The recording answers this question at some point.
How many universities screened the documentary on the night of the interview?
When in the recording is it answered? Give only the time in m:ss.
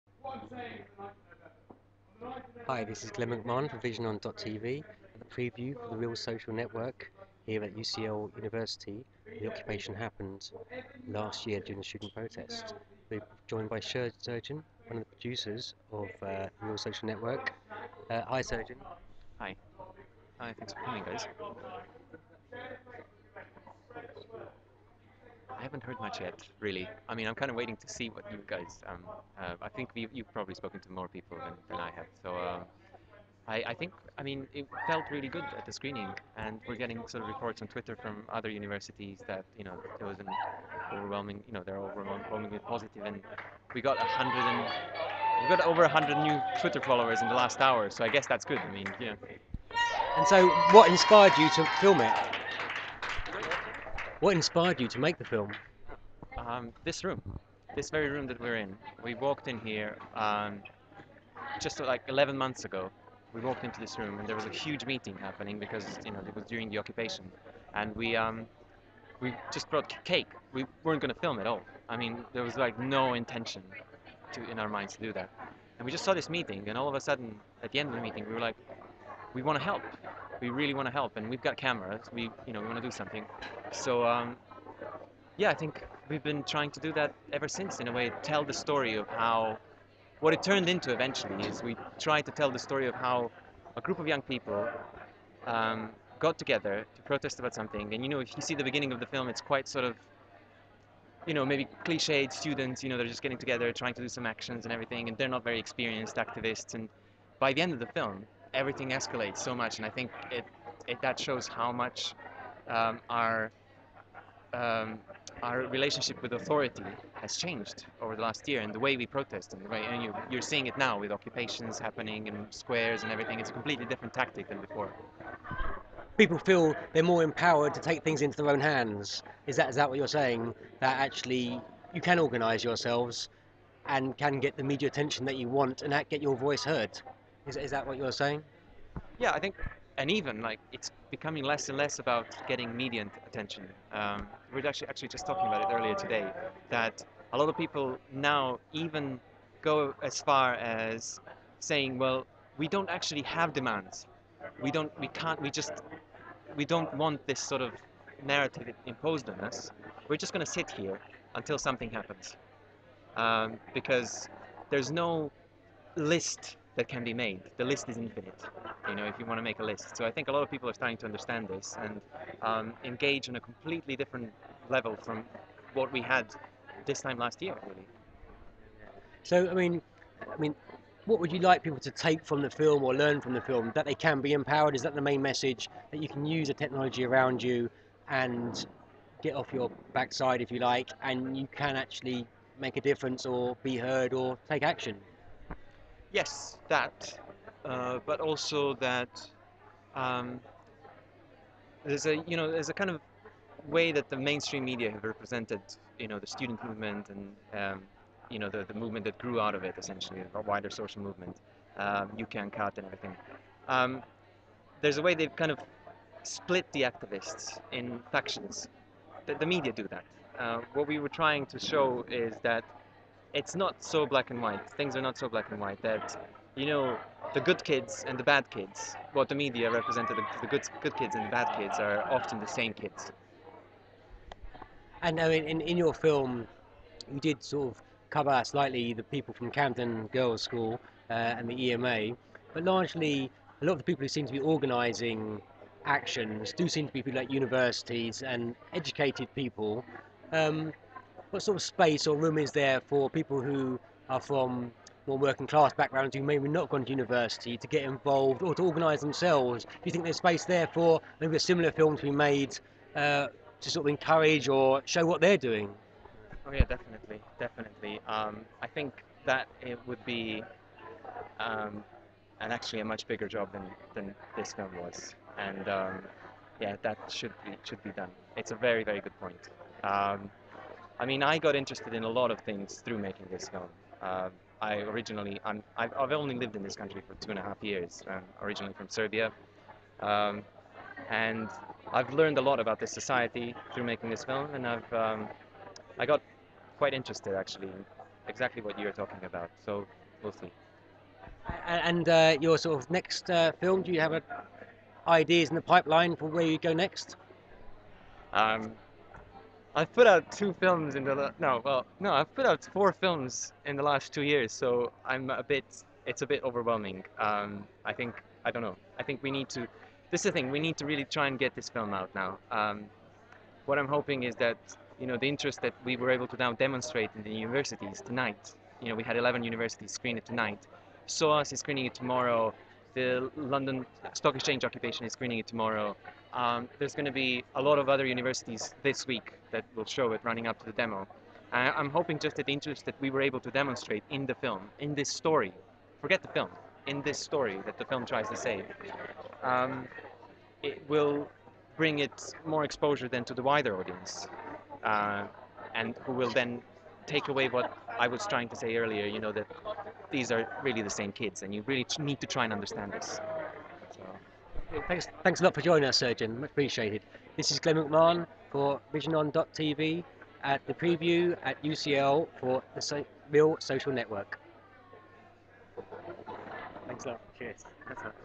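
5:29.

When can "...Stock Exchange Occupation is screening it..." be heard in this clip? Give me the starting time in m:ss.
5:34.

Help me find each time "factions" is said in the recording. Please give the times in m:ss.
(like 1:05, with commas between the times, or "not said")
3:38.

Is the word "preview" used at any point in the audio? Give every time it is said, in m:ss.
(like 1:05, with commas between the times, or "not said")
0:05, 6:10.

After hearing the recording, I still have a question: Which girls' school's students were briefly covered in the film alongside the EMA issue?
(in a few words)
Camden Girls' School.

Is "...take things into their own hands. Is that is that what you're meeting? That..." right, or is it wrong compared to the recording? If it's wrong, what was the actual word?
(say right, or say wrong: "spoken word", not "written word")
wrong: "saying", not "meeting".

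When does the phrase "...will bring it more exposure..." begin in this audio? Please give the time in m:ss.
5:50.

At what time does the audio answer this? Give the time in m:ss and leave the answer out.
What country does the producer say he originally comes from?
4:48.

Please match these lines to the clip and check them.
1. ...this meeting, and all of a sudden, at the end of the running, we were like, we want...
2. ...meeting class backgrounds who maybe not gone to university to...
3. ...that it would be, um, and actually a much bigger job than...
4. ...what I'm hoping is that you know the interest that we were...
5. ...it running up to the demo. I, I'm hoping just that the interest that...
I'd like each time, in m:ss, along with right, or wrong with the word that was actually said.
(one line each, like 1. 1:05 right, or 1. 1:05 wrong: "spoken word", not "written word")
1. 1:16 wrong: "meeting", not "running"
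2. 4:15 wrong: "working", not "meeting"
3. 4:29 right
4. 5:23 right
5. 5:40 right.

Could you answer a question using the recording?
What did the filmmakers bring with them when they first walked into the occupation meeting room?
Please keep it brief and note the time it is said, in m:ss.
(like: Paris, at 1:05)
cake, at 1:10.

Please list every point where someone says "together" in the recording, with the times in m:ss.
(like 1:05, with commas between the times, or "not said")
1:36, 1:43.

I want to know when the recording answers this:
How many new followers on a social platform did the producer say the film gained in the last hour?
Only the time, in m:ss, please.
0:45.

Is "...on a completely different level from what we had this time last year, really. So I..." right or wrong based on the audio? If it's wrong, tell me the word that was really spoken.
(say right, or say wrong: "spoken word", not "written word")
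right.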